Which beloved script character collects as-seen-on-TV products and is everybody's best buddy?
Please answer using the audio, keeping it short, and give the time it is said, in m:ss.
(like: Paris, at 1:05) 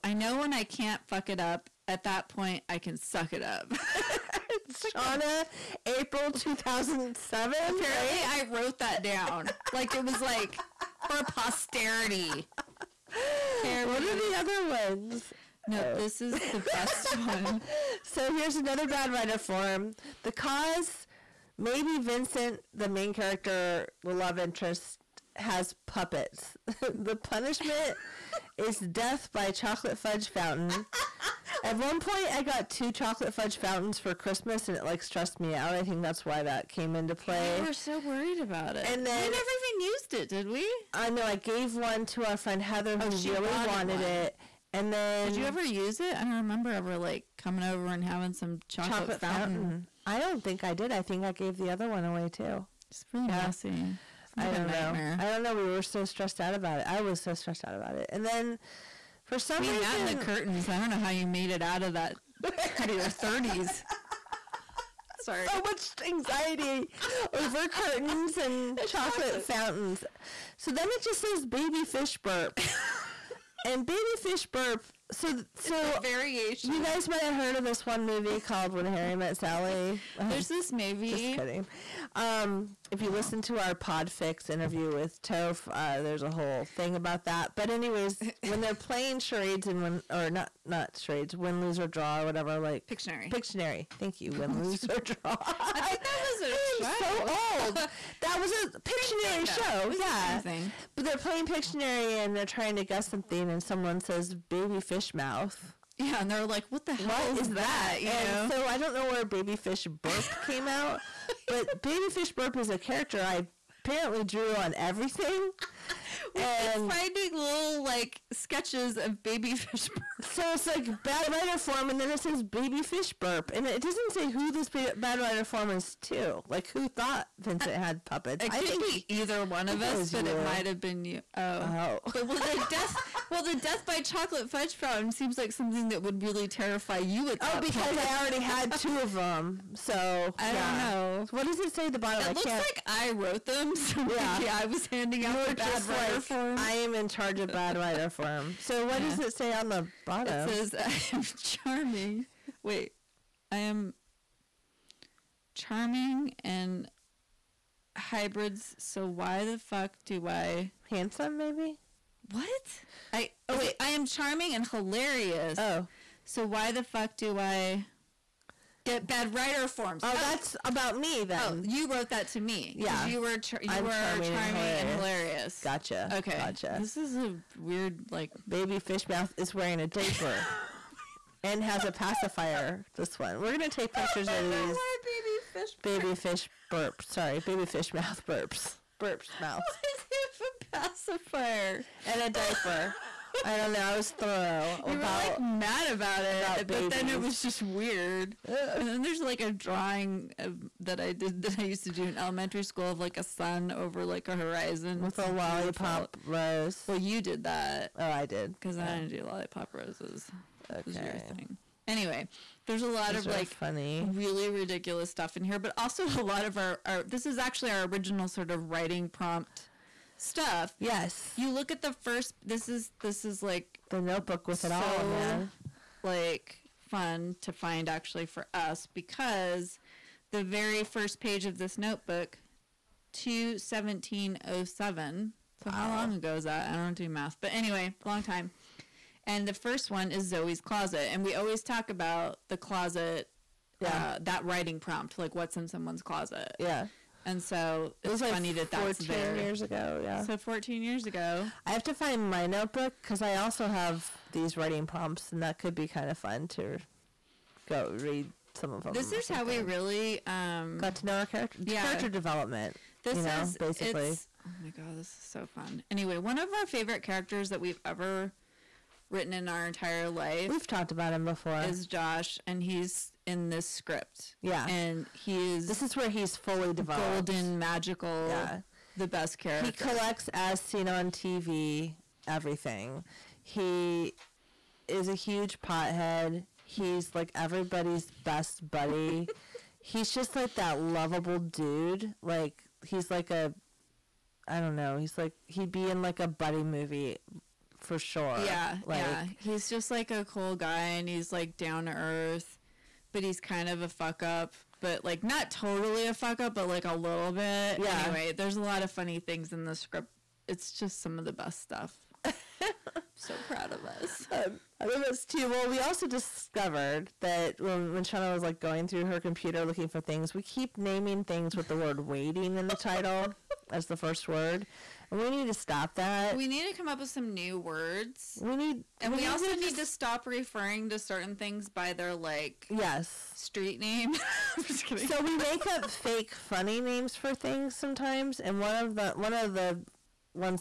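Josh, at 4:31.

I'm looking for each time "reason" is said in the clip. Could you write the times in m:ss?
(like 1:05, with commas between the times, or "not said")
0:59.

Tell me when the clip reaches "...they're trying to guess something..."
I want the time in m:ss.
1:42.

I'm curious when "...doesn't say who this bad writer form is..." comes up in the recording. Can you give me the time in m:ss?
2:03.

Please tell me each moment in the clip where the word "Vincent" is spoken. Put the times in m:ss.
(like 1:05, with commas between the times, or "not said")
0:21, 2:07.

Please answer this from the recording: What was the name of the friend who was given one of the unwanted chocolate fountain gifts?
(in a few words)
Heather.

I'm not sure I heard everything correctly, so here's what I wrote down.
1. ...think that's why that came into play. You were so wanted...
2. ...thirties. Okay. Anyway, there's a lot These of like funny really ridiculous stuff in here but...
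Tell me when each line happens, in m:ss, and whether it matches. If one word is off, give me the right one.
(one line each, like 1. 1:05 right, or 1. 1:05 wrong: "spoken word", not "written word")
1. 0:35 wrong: "worried", not "wanted"
2. 3:29 wrong: "roses", not "thirties".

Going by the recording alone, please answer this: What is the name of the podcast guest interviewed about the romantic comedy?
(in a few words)
Toph.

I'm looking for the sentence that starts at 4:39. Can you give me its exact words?
He collects as seen on TV everything.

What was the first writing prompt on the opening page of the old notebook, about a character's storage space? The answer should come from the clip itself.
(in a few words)
Zoe's closet.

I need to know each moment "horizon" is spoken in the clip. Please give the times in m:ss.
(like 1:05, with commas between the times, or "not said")
3:24.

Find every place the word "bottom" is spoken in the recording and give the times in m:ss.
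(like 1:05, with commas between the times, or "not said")
2:21, 2:30.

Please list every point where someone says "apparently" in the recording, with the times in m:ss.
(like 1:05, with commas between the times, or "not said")
0:07, 1:53.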